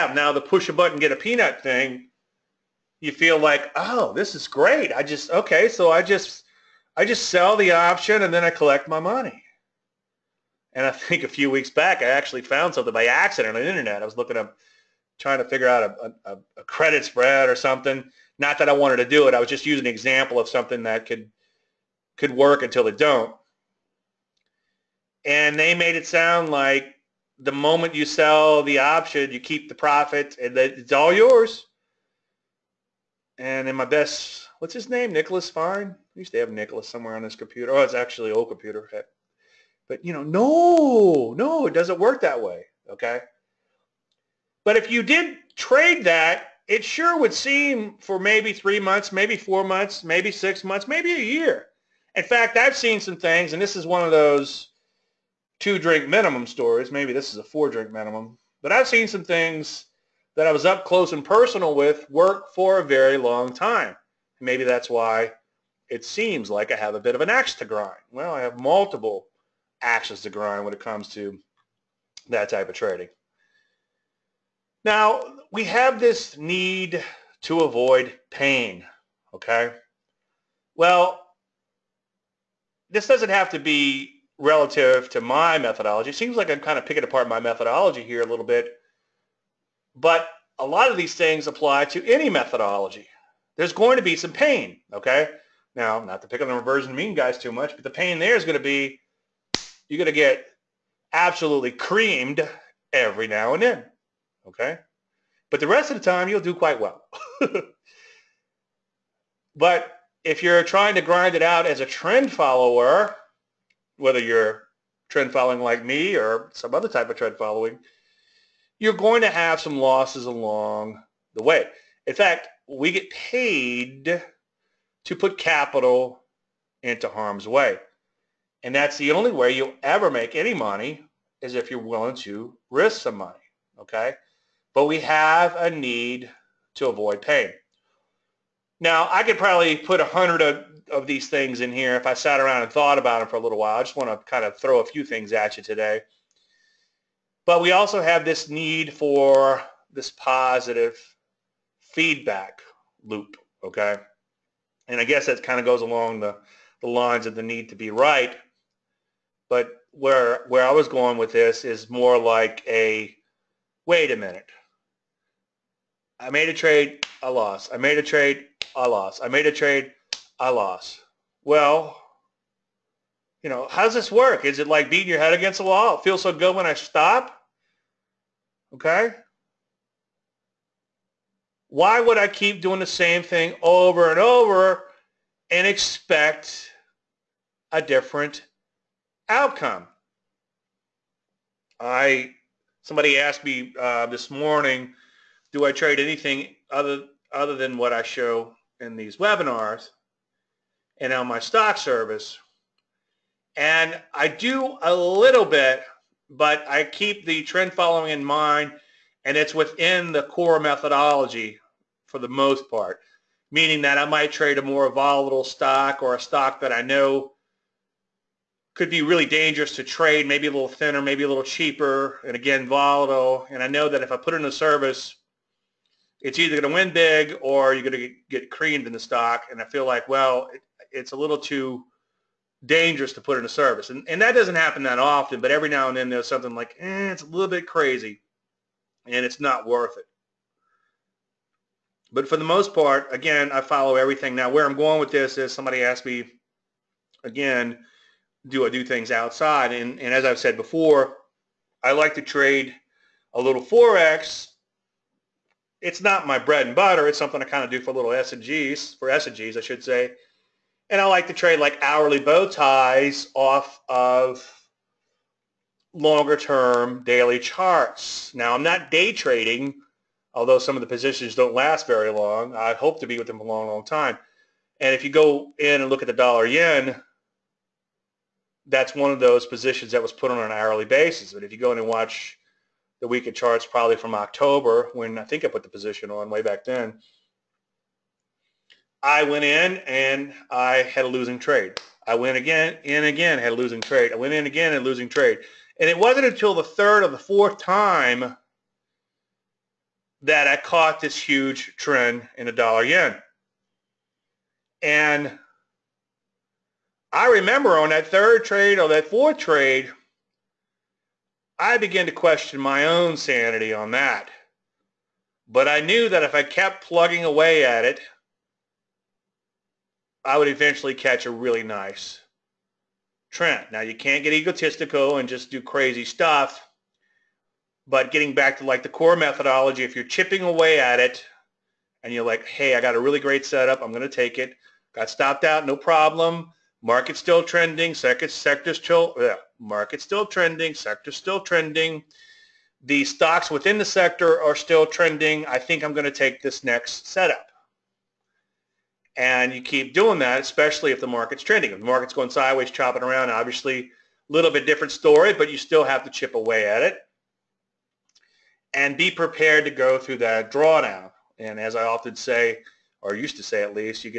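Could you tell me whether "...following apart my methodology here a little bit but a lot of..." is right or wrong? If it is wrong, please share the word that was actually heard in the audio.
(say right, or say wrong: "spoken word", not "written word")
wrong: "picking", not "following".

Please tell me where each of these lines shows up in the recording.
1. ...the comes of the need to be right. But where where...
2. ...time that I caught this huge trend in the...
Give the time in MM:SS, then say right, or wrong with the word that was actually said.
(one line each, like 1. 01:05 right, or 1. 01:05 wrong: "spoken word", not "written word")
1. 02:36 wrong: "lines", not "comes"
2. 04:57 right.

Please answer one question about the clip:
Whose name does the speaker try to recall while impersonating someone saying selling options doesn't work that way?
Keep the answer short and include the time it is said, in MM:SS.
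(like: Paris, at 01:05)
Nicholas Fine, at 00:35.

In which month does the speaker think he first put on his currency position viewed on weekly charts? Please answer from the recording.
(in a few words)
October.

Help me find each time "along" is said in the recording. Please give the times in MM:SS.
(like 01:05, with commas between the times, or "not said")
02:00, 02:35.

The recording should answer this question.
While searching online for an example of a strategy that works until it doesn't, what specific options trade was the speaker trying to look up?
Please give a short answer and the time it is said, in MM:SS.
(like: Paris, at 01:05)
credit spread, at 00:16.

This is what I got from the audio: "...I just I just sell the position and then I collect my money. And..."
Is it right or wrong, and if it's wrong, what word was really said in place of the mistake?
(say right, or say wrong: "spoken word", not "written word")
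wrong: "option", not "position".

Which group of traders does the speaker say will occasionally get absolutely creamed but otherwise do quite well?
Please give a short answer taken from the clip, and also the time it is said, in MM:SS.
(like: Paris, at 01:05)
reversion mean guys, at 01:36.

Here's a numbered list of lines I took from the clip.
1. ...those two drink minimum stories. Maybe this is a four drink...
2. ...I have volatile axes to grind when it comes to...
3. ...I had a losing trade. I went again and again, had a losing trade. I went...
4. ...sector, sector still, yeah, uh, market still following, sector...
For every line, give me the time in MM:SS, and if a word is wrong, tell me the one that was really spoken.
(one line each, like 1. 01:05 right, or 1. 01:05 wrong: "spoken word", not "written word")
1. 00:54 right
2. 01:08 wrong: "multiple", not "volatile"
3. 04:50 right
4. 05:37 wrong: "trending", not "following".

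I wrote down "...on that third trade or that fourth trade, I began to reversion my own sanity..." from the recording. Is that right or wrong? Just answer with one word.
wrong.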